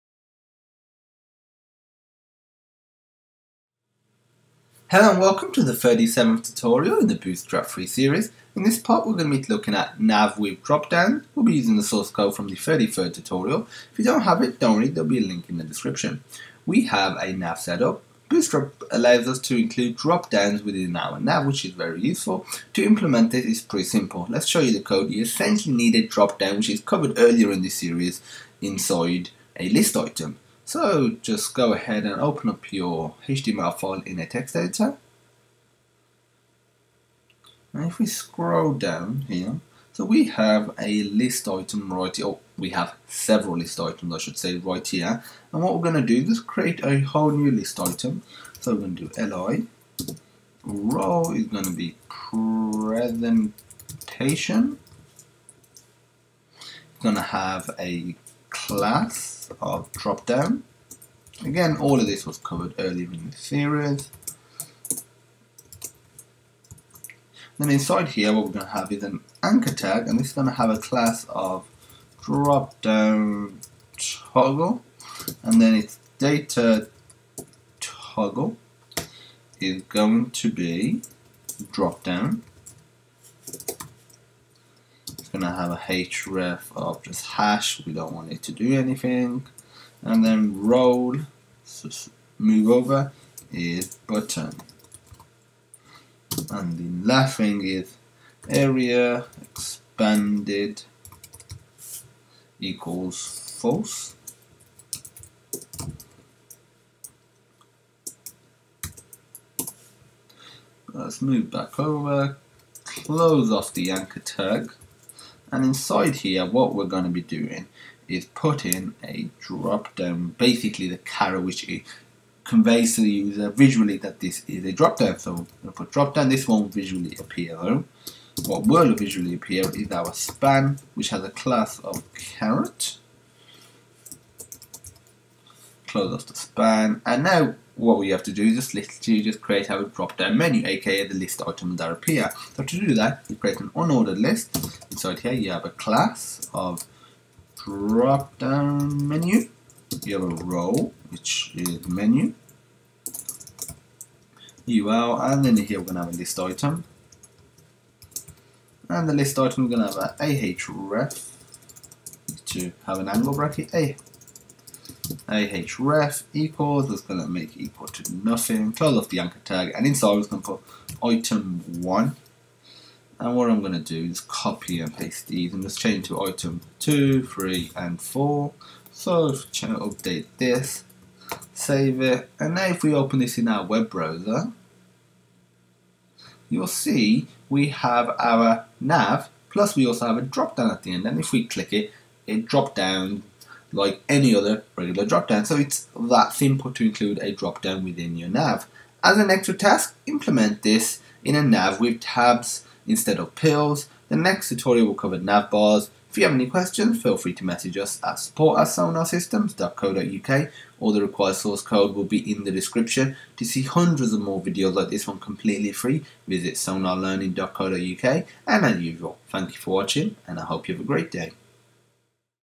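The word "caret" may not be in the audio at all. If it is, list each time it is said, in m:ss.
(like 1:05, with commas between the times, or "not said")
2:00, 2:12.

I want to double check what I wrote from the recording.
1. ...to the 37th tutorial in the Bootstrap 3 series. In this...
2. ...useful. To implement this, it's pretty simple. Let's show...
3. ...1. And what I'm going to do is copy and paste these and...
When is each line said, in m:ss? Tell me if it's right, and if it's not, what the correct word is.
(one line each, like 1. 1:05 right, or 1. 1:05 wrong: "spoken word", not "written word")
1. 0:05 right
2. 0:22 right
3. 2:51 right.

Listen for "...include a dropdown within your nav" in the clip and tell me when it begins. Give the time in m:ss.
3:16.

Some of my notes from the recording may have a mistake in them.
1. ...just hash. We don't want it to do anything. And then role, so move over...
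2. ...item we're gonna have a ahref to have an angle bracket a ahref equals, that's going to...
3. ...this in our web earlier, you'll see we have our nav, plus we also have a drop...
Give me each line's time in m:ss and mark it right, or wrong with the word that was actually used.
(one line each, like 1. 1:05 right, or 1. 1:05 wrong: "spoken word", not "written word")
1. 1:27 right
2. 2:39 right
3. 3:03 wrong: "browser", not "earlier".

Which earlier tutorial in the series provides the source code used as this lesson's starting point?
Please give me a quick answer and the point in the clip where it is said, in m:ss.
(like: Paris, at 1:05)
33rd, at 0:12.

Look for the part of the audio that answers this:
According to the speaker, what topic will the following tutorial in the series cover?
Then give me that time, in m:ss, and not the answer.
3:25.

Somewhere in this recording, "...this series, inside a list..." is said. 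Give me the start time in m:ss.
0:27.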